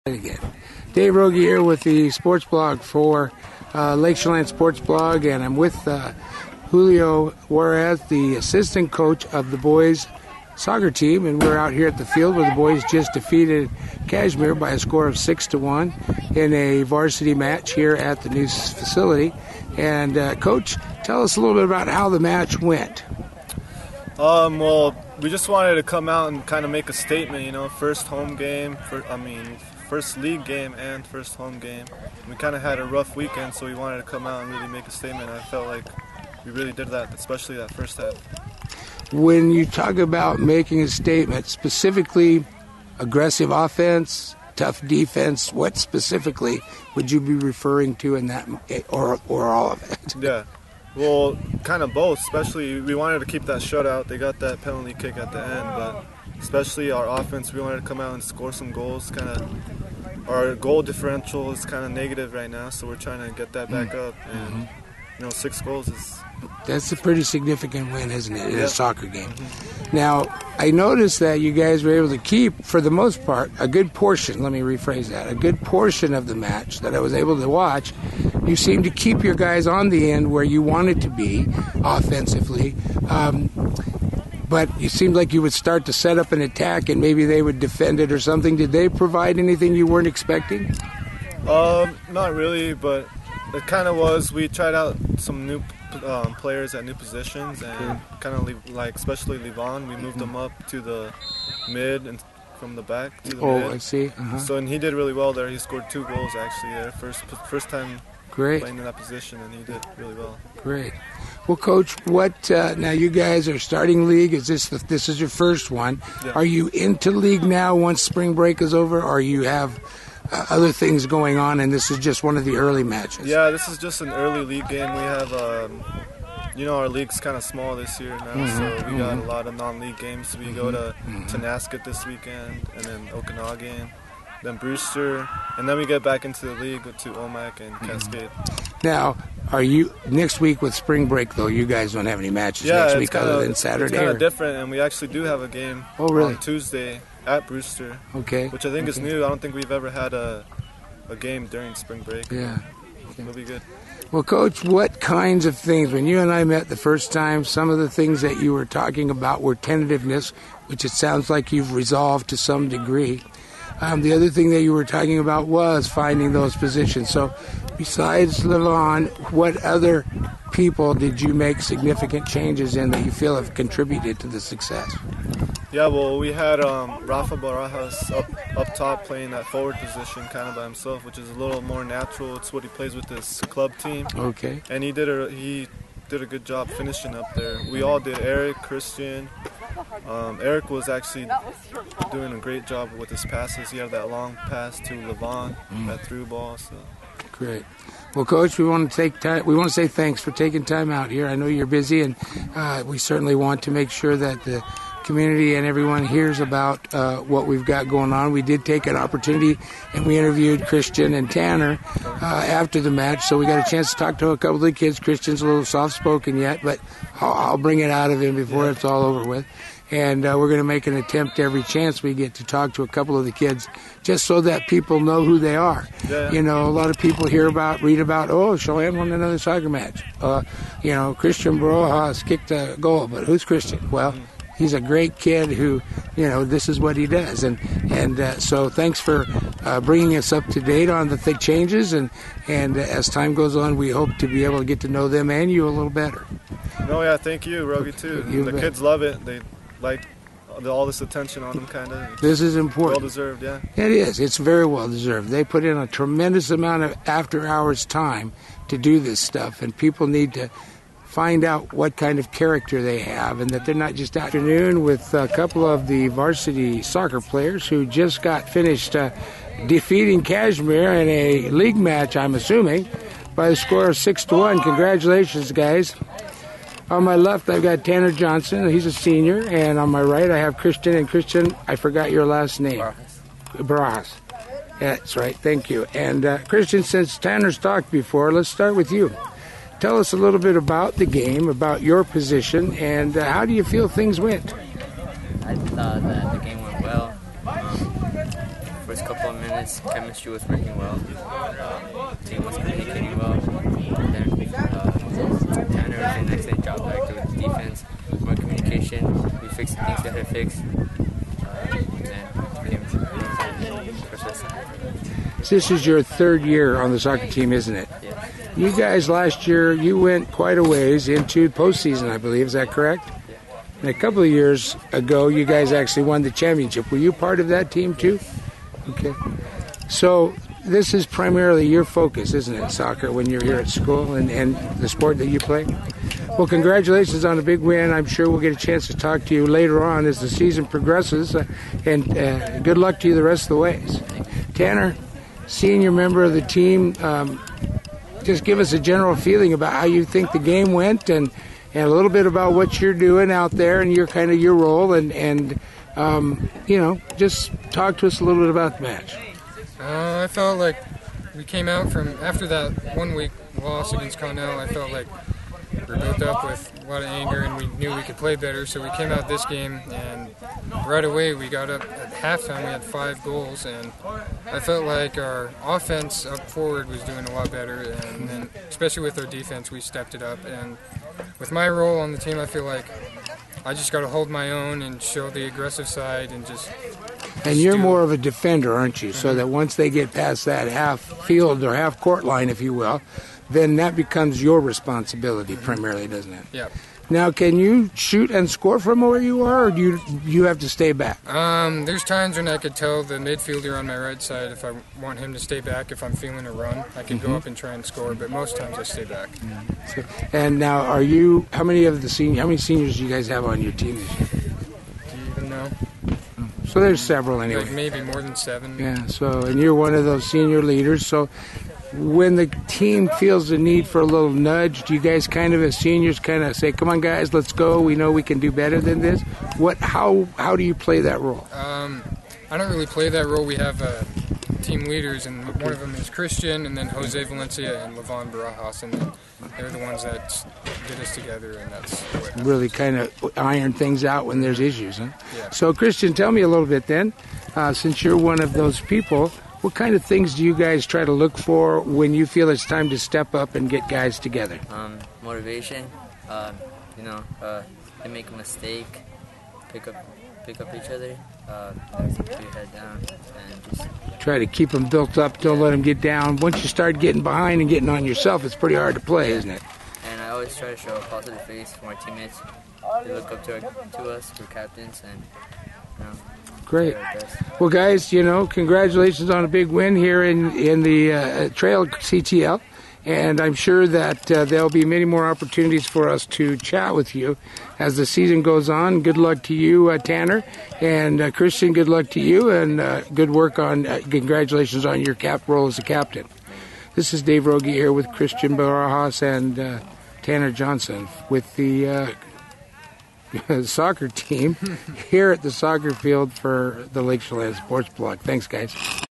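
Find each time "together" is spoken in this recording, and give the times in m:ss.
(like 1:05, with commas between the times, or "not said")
7:21, 7:34.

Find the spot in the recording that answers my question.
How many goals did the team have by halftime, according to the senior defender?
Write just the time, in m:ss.
6:12.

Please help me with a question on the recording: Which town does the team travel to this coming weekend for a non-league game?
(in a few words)
Tonasket.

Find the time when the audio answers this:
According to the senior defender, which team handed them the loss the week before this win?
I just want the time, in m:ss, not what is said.
6:04.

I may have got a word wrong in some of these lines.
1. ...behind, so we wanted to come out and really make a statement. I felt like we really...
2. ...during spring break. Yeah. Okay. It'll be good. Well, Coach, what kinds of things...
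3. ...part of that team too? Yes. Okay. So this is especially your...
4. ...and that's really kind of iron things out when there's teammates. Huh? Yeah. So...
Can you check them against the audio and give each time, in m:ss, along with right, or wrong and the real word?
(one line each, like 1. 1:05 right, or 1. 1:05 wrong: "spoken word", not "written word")
1. 0:33 wrong: "weekend", not "behind"
2. 2:31 right
3. 5:27 wrong: "primarily", not "especially"
4. 7:21 wrong: "issues", not "teammates".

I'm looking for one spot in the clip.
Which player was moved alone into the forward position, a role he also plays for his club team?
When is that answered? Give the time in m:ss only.
2:57.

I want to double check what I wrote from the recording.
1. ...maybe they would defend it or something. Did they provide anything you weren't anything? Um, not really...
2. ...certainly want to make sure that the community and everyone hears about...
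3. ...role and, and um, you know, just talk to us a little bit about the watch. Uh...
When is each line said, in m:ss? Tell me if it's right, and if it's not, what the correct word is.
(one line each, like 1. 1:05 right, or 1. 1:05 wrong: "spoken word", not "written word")
1. 1:26 wrong: "expecting", not "anything"
2. 3:22 right
3. 5:54 wrong: "match", not "watch".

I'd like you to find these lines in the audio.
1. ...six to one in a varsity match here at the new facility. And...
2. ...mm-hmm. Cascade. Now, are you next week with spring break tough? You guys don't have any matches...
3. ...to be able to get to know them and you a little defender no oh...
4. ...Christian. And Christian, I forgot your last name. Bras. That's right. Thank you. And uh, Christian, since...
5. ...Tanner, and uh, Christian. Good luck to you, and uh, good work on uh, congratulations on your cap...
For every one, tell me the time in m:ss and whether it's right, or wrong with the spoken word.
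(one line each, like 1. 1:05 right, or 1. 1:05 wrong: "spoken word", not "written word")
1. 0:15 right
2. 2:17 wrong: "though", not "tough"
3. 4:04 wrong: "better", not "defender"
4. 4:40 right
5. 8:09 right.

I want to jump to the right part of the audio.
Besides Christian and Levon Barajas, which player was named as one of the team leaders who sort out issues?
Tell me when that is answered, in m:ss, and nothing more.
7:16.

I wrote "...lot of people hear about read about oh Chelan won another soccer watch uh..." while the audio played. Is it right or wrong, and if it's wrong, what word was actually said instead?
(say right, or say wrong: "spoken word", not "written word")
wrong: "match", not "watch".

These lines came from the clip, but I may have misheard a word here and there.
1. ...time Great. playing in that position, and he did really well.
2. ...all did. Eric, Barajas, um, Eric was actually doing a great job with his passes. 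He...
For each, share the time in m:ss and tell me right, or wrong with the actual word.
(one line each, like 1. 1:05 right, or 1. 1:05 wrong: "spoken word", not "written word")
1. 1:47 right
2. 3:07 wrong: "Christian", not "Barajas".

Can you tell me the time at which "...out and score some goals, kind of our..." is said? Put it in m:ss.
0:58.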